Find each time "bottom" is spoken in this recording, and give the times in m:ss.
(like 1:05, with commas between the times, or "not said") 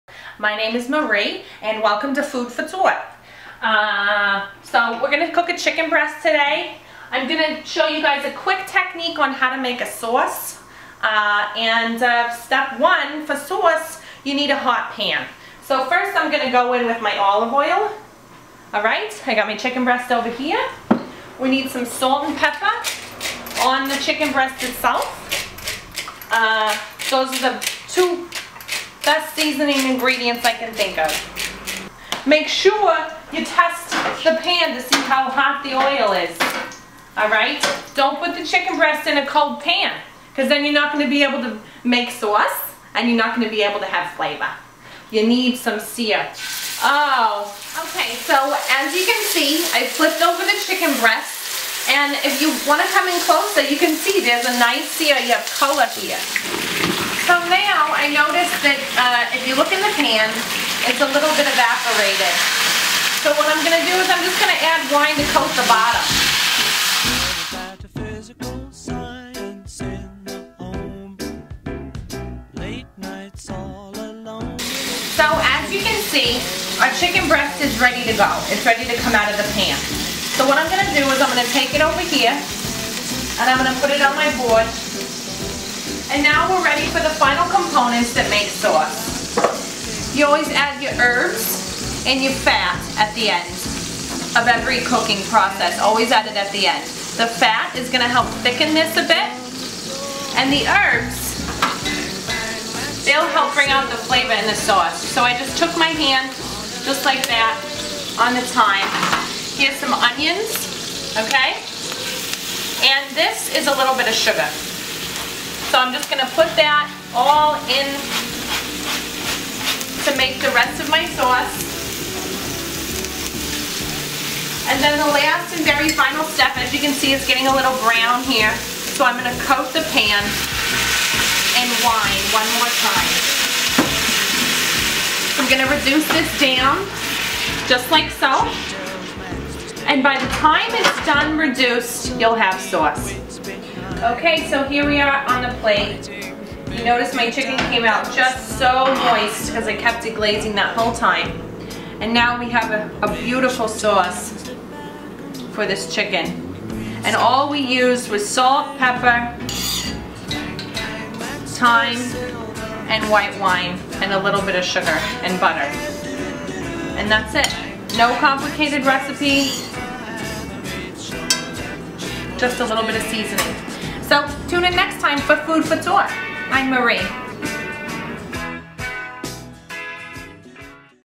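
1:05.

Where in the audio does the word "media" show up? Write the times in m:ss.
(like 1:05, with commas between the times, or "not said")
not said.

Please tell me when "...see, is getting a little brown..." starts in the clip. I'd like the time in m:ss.
2:06.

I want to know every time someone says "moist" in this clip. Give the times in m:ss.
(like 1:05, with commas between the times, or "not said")
2:29.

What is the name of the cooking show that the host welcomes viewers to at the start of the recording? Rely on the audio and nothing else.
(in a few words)
Food for Thought.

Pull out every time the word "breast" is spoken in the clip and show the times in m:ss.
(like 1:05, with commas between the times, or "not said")
0:05, 0:19, 0:24, 0:38, 0:51, 1:17.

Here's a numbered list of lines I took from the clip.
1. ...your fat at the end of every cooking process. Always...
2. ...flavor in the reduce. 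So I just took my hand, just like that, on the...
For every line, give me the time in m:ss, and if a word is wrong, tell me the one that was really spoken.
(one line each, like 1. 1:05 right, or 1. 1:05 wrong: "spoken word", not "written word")
1. 1:32 right
2. 1:44 wrong: "sauce", not "reduce".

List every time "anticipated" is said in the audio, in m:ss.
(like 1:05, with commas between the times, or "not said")
not said.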